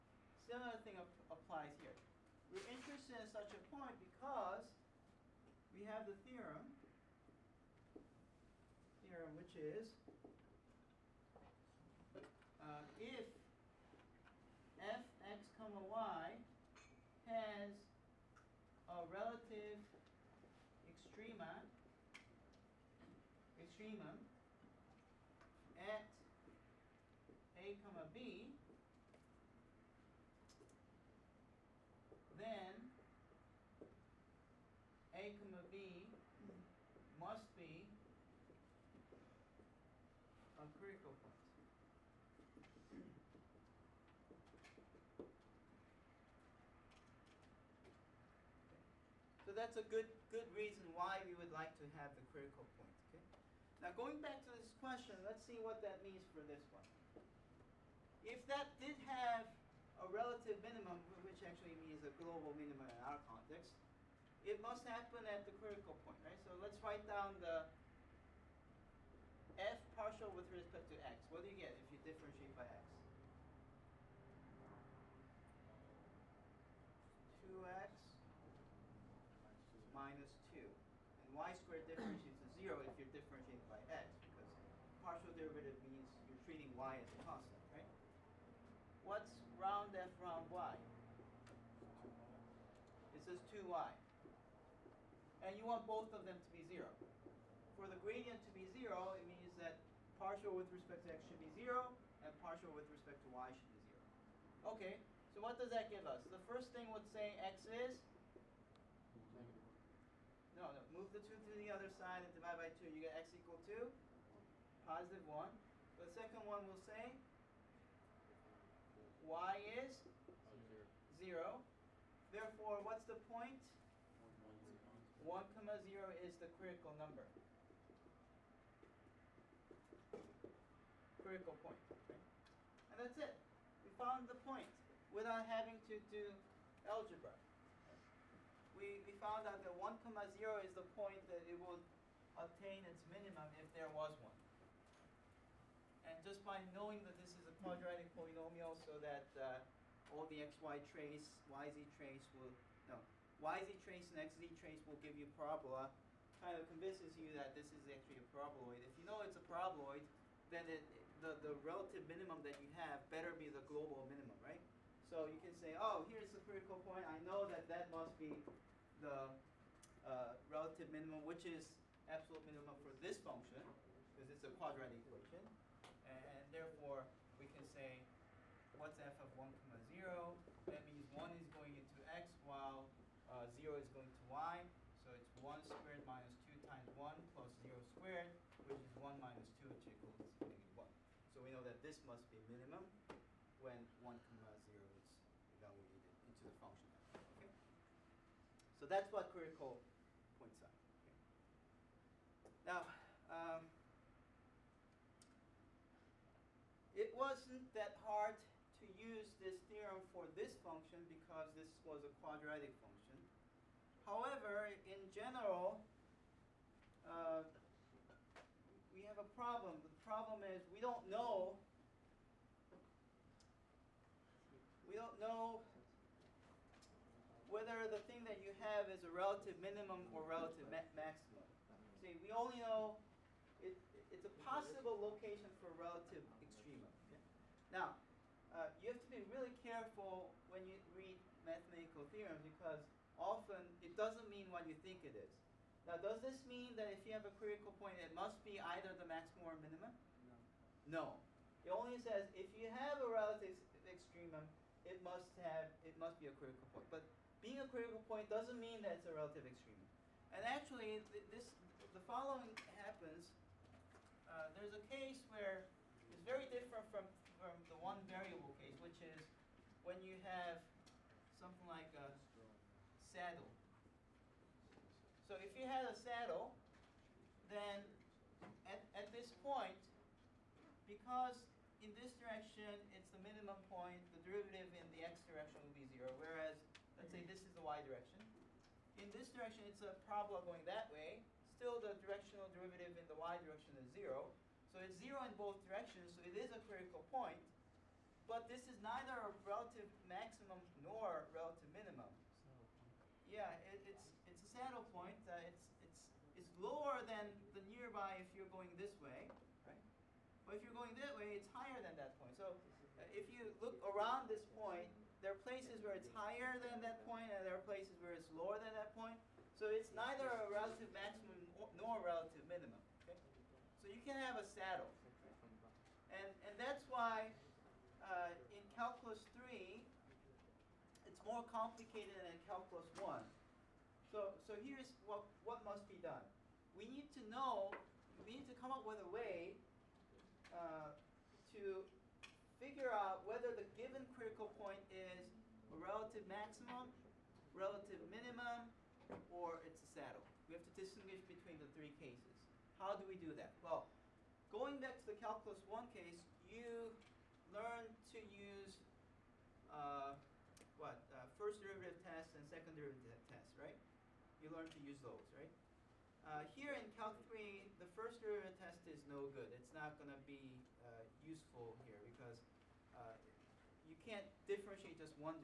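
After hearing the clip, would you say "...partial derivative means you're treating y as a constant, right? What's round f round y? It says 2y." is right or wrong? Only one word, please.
right.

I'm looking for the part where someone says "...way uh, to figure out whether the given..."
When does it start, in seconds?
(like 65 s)
339 s.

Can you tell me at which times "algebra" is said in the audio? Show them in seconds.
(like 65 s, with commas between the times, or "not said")
136 s.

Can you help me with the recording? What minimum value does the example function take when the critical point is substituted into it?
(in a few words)
-1.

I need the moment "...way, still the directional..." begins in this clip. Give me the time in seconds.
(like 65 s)
290 s.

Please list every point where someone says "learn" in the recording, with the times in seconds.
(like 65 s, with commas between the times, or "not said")
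357 s, 364 s.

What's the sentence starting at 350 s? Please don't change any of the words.
We have to distinguish between the three cases.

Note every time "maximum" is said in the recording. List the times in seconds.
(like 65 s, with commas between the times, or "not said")
230 s, 249 s, 300 s, 320 s, 346 s.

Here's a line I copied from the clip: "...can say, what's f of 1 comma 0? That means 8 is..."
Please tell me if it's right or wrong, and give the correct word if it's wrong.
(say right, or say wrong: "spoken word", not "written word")
wrong: "1", not "8".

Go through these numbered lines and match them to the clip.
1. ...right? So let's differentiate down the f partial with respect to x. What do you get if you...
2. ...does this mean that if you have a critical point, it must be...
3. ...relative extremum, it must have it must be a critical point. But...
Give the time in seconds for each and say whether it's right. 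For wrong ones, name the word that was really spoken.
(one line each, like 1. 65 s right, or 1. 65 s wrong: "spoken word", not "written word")
1. 66 s wrong: "write", not "differentiate"
2. 245 s right
3. 253 s right.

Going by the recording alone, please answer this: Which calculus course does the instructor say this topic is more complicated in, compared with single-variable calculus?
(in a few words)
Calculus 3.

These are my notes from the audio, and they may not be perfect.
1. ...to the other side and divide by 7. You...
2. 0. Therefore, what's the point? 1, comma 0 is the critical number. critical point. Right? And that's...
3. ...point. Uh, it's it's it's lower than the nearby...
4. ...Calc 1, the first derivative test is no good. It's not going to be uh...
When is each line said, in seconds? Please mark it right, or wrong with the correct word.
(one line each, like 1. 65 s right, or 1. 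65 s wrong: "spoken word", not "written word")
1. 111 s wrong: "2", not "7"
2. 121 s right
3. 304 s right
4. 366 s wrong: "3", not "1".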